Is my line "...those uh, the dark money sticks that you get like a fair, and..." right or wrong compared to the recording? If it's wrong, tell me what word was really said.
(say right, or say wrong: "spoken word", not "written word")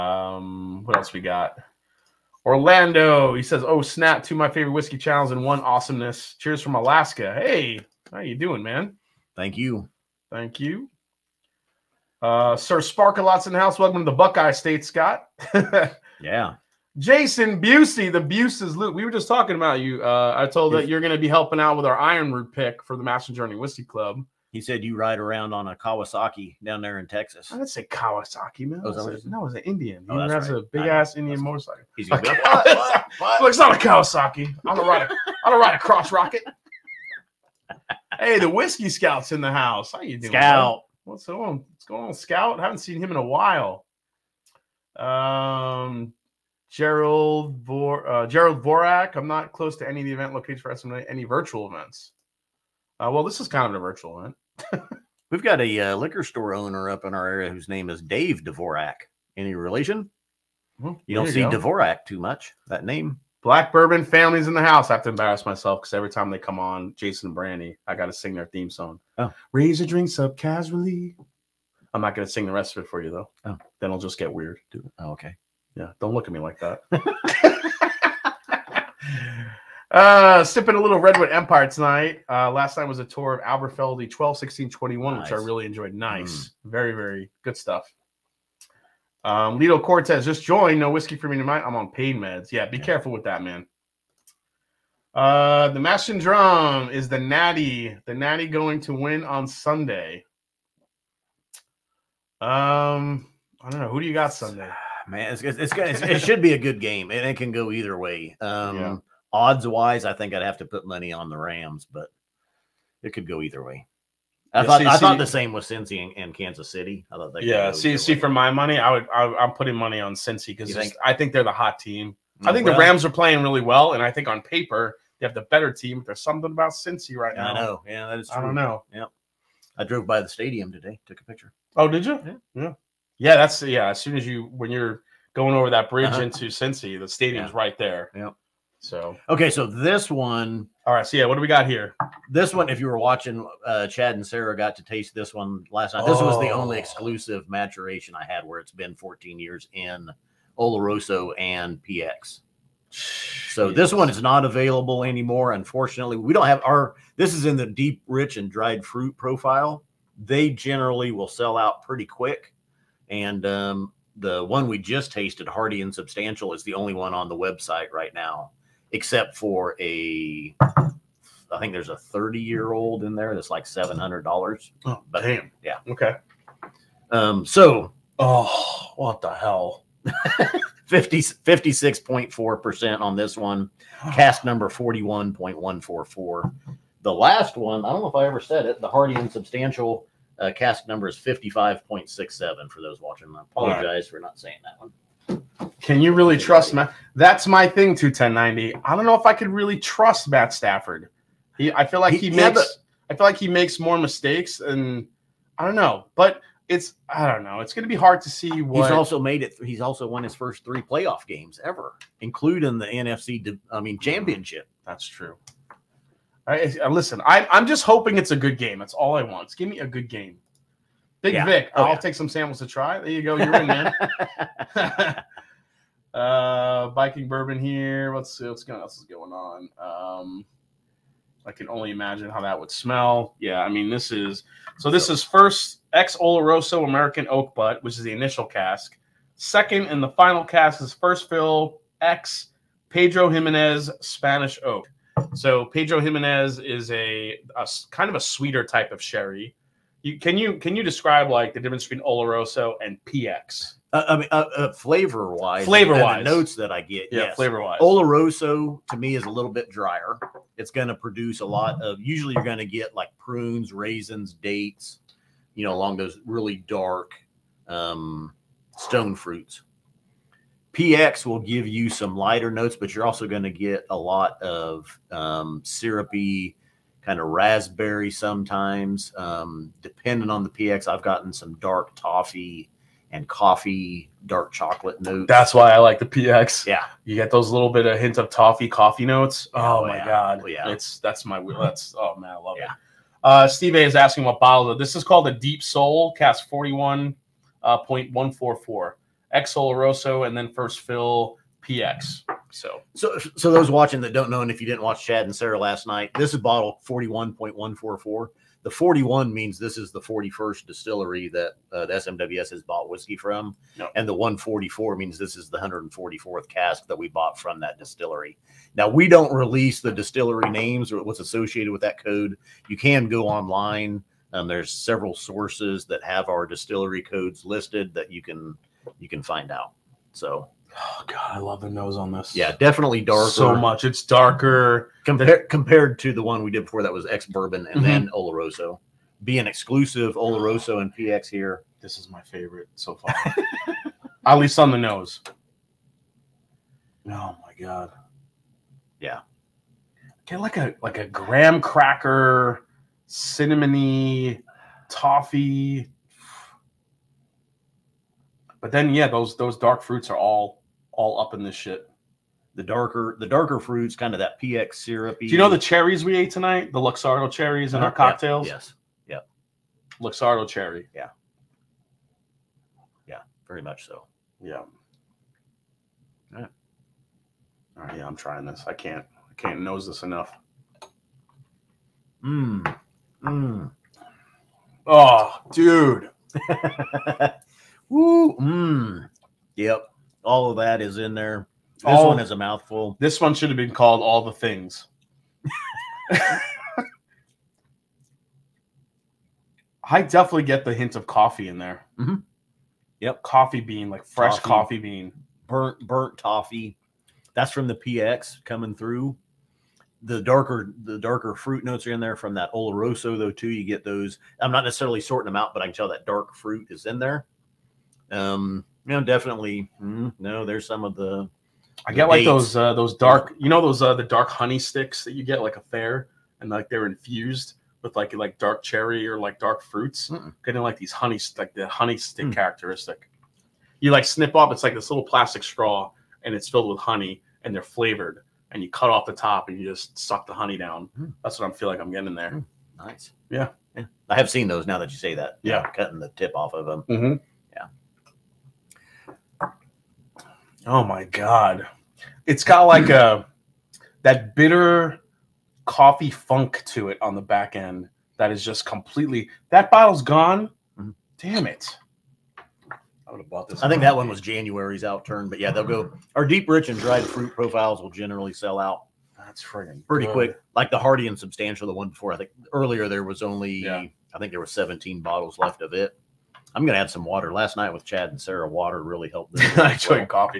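wrong: "honey", not "money".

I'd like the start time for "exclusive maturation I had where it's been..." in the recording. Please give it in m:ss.
2:26.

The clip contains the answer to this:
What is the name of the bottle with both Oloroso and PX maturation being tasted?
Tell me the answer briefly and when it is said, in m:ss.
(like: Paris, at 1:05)
Deep Soul, at 4:55.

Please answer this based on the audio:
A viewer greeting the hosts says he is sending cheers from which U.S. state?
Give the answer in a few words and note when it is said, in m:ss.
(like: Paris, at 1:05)
Alaska, at 0:06.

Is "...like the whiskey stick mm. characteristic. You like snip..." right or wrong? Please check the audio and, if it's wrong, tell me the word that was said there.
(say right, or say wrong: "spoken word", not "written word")
wrong: "honey", not "whiskey".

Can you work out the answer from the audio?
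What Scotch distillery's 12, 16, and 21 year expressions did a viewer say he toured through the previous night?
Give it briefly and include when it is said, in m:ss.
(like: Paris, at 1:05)
Aberfeldy, at 1:23.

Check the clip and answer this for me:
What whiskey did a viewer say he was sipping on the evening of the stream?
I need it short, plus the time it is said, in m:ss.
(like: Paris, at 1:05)
Redwood Empire, at 1:20.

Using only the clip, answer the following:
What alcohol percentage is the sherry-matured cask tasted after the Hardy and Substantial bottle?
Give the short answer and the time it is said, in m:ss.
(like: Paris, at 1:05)
56.4%, at 3:01.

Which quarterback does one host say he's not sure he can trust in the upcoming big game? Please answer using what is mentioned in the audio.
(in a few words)
Matt Stafford.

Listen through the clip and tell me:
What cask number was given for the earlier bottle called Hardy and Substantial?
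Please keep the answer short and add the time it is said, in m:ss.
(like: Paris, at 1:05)
55.67, at 3:11.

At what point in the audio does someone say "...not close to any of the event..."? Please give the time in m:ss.
0:49.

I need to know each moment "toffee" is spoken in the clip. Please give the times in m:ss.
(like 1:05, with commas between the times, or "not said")
4:41, 4:48, 5:54, 6:46.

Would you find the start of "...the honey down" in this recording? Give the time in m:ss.
7:20.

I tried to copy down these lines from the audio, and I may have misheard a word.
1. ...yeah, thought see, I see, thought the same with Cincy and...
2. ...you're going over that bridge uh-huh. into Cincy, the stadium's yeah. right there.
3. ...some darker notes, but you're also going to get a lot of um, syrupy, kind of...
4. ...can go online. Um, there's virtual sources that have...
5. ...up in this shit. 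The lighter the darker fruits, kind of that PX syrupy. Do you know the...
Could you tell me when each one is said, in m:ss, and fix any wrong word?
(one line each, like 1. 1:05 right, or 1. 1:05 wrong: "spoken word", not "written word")
1. 1:54 right
2. 2:14 right
3. 4:31 wrong: "lighter", not "darker"
4. 5:22 wrong: "several", not "virtual"
5. 6:01 wrong: "darker", not "lighter".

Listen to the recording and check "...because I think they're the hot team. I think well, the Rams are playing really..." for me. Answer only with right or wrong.
right.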